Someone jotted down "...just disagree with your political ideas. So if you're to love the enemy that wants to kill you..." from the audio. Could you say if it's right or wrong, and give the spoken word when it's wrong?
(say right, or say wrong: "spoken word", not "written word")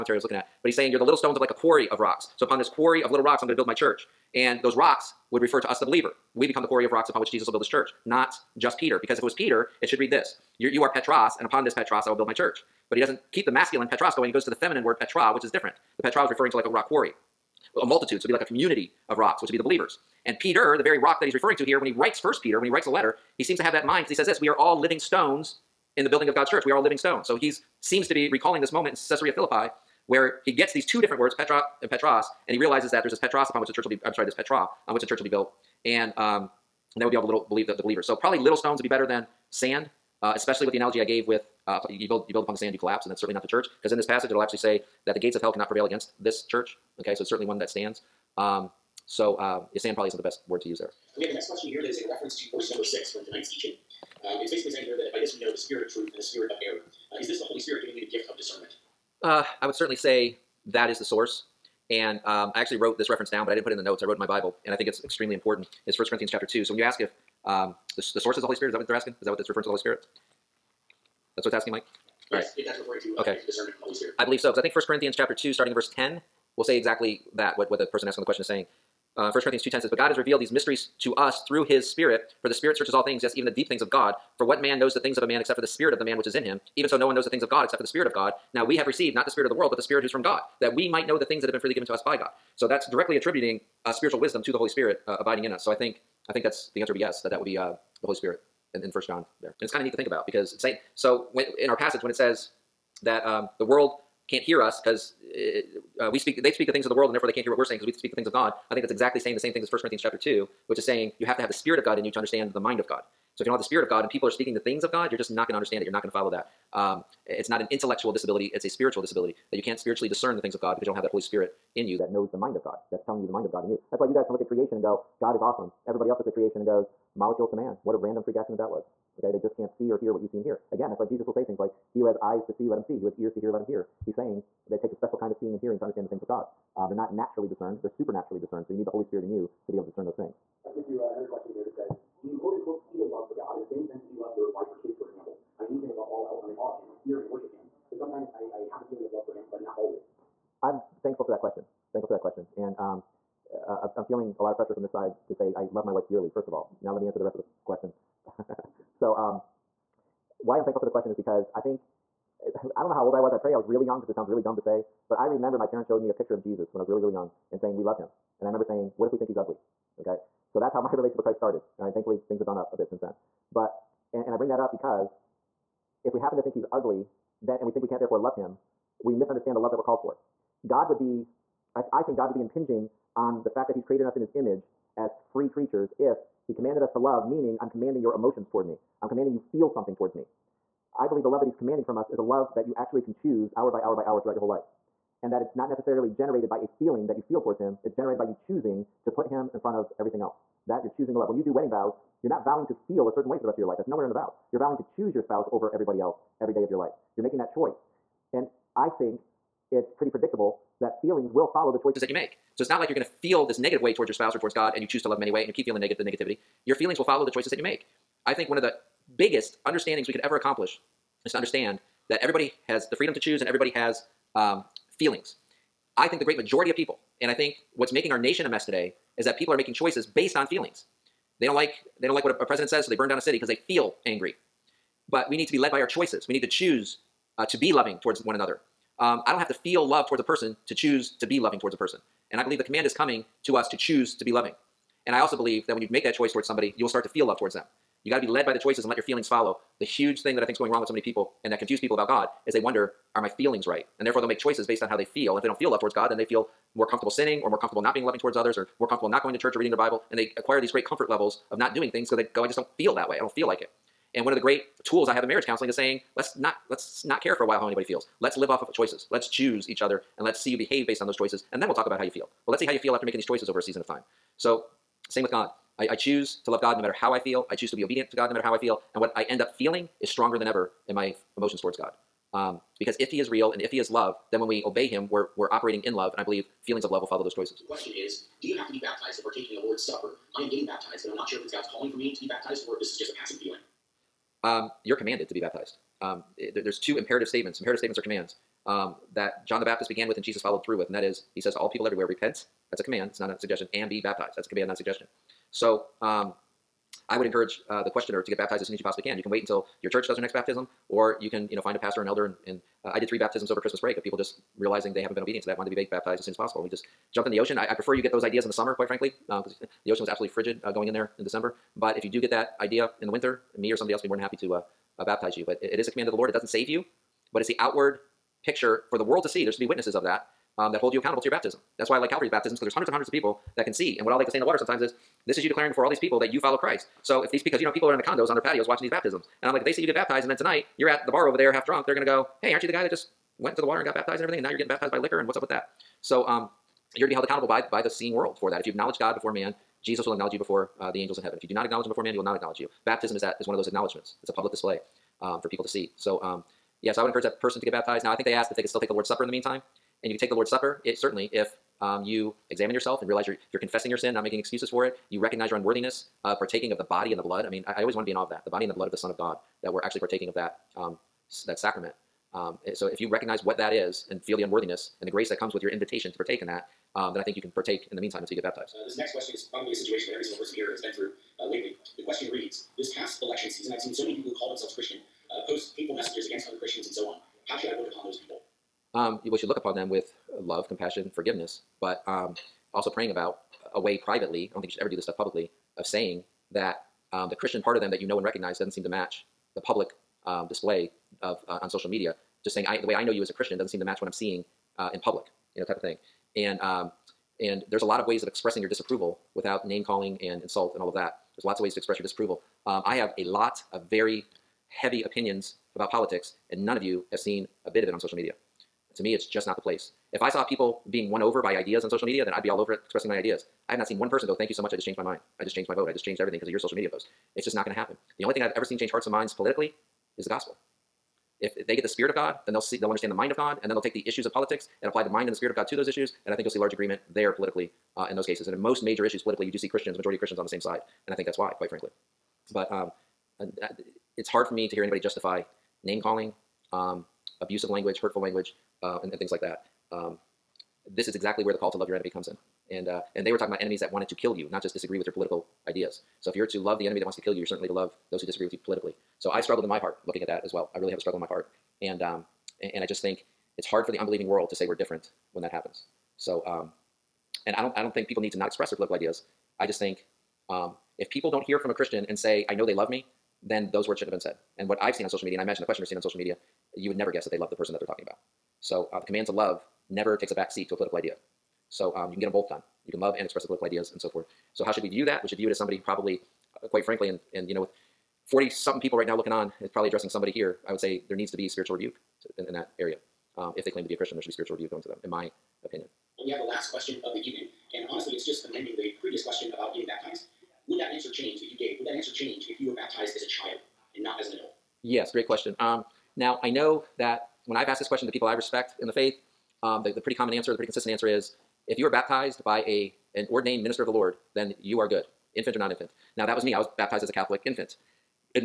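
right.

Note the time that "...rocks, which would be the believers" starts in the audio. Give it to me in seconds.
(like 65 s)
19 s.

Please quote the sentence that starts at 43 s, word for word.
Because in this passage, it'll actually say that the gates of hell cannot prevail against this church.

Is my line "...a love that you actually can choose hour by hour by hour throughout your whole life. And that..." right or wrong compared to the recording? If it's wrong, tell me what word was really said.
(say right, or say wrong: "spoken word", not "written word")
right.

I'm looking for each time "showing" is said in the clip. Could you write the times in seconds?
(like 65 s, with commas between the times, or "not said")
165 s.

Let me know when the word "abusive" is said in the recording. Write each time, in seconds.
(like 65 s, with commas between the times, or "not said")
447 s.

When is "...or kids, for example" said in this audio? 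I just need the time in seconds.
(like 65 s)
144 s.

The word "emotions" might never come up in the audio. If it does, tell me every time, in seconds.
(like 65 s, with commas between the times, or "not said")
188 s, 281 s.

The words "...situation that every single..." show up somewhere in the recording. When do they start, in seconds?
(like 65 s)
379 s.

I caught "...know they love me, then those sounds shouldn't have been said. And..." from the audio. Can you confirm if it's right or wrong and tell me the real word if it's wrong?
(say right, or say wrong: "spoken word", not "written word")
wrong: "words", not "sounds".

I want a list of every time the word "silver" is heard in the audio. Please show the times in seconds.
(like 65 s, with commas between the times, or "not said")
not said.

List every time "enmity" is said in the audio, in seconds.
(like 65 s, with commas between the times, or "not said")
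not said.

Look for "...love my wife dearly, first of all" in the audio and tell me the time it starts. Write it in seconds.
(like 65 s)
155 s.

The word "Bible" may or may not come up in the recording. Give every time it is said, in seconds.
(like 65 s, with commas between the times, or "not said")
64 s, 259 s.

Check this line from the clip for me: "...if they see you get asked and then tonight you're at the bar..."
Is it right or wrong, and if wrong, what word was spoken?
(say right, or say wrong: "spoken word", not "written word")
wrong: "baptized", not "asked".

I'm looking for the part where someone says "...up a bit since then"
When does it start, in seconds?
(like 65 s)
172 s.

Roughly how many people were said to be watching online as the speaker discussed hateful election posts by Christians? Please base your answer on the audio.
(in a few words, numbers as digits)
40 something.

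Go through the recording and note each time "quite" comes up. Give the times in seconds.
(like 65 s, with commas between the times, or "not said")
318 s, 441 s, 486 s.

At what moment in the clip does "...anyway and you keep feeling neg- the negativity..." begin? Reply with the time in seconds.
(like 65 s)
215 s.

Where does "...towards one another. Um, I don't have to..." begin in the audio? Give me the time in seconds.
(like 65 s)
238 s.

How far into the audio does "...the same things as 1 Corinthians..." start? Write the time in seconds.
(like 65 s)
109 s.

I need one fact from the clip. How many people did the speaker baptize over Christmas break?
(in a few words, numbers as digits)
3.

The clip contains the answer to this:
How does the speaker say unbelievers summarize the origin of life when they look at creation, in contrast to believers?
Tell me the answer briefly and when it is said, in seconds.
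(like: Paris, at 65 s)
Molecules to man, at 127 s.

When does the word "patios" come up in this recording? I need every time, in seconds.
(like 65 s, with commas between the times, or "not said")
338 s.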